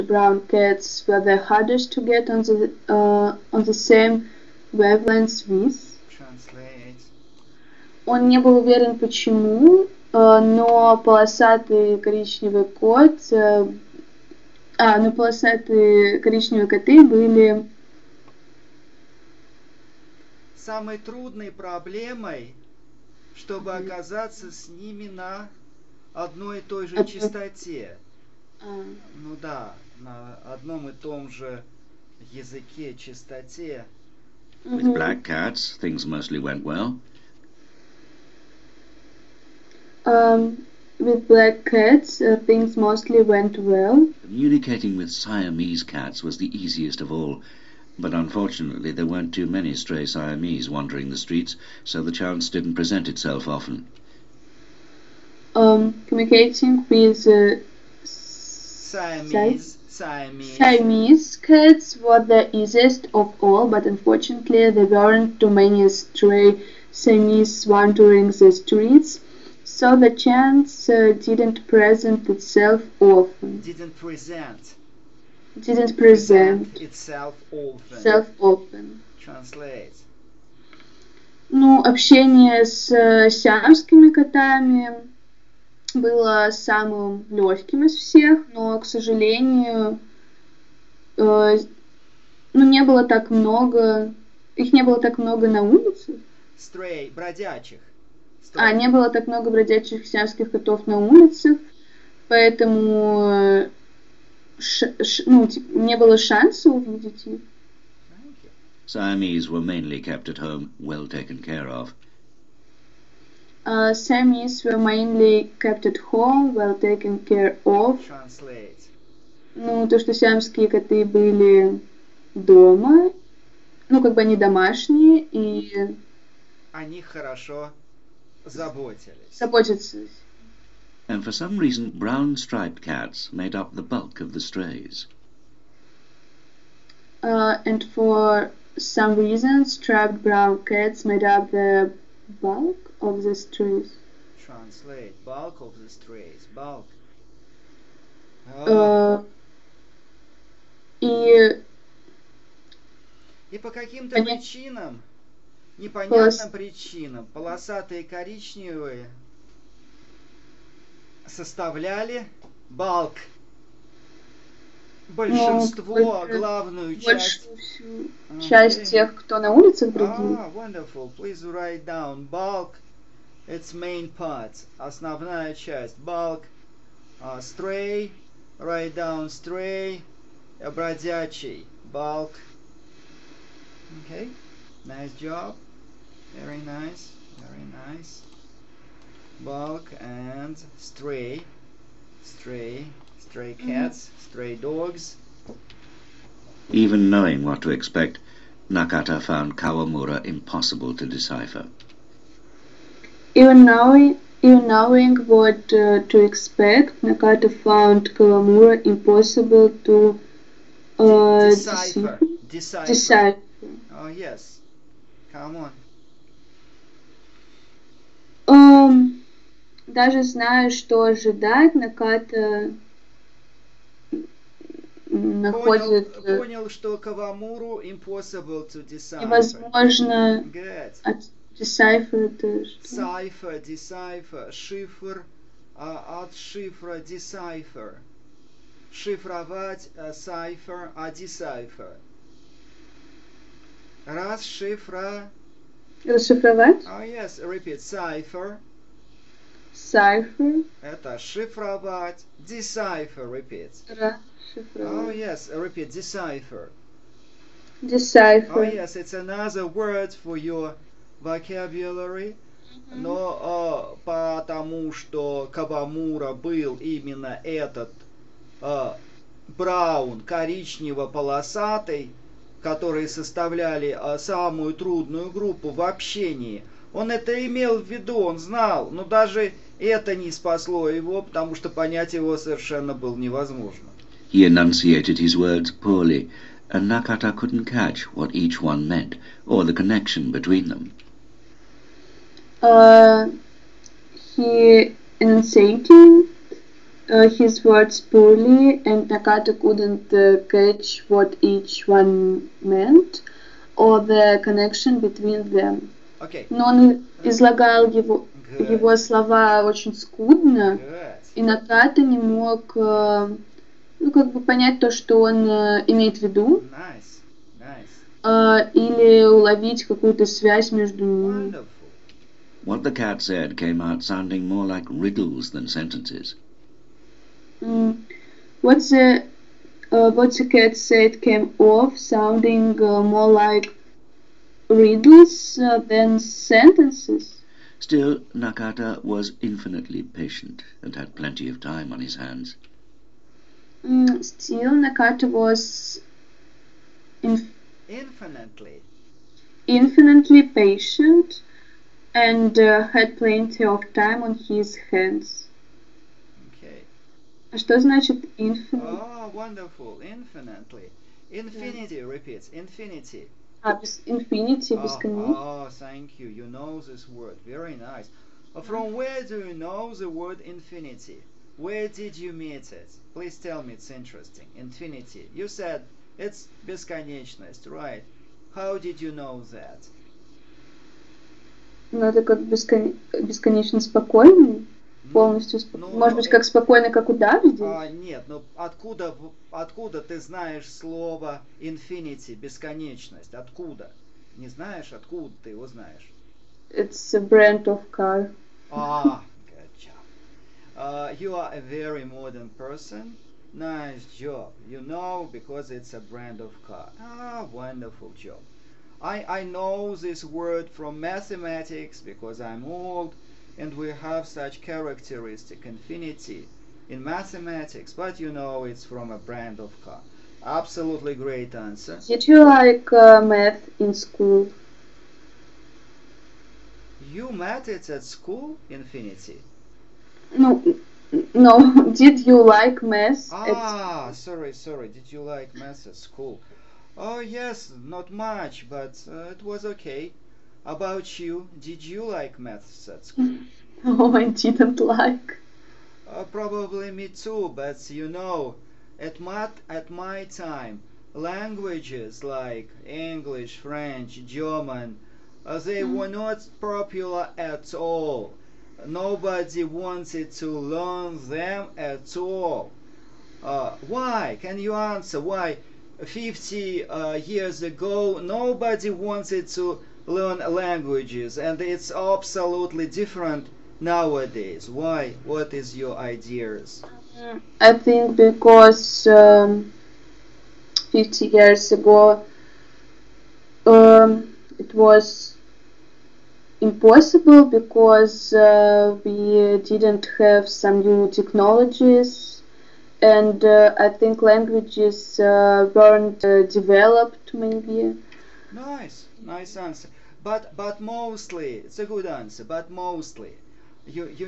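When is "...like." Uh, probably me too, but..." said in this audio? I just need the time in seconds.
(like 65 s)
444 s.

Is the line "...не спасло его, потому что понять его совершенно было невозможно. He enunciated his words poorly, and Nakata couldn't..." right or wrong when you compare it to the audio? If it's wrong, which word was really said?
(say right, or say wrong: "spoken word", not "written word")
right.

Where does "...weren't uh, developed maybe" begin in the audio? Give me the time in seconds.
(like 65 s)
495 s.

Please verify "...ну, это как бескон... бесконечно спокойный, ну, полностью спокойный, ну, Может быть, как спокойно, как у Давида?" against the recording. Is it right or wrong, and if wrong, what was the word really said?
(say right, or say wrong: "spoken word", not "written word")
right.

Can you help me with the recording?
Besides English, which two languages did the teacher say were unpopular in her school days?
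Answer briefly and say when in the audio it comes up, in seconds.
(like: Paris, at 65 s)
French, German, at 453 s.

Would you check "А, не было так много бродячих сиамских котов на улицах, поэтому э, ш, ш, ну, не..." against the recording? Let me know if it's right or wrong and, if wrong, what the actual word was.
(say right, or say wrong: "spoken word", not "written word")
right.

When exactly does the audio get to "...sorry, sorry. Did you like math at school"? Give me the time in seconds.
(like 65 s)
434 s.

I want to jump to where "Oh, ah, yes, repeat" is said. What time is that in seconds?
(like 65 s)
254 s.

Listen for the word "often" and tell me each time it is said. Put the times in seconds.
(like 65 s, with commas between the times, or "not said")
53 s, 73 s, 77 s.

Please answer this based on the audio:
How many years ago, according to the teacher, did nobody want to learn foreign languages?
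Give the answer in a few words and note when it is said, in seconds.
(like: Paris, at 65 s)
50, at 466 s.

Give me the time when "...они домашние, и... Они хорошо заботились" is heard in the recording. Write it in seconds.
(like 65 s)
124 s.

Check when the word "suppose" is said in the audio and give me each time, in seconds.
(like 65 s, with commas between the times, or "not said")
not said.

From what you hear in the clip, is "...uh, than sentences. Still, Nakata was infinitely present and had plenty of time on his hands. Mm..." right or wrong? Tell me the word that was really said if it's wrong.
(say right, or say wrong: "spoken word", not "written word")
wrong: "patient", not "present".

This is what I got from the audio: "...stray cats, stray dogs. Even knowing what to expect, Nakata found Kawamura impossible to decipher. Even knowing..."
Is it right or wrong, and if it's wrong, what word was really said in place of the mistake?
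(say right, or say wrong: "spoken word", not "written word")
right.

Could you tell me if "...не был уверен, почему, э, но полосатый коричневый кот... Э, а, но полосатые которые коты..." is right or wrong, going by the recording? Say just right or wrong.
wrong.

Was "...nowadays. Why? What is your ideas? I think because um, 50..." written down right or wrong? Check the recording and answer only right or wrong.
right.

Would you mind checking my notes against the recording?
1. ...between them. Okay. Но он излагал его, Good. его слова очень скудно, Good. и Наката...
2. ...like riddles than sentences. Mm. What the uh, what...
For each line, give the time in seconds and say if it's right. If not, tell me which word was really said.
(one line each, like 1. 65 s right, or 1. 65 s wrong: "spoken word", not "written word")
1. 305 s right
2. 324 s right.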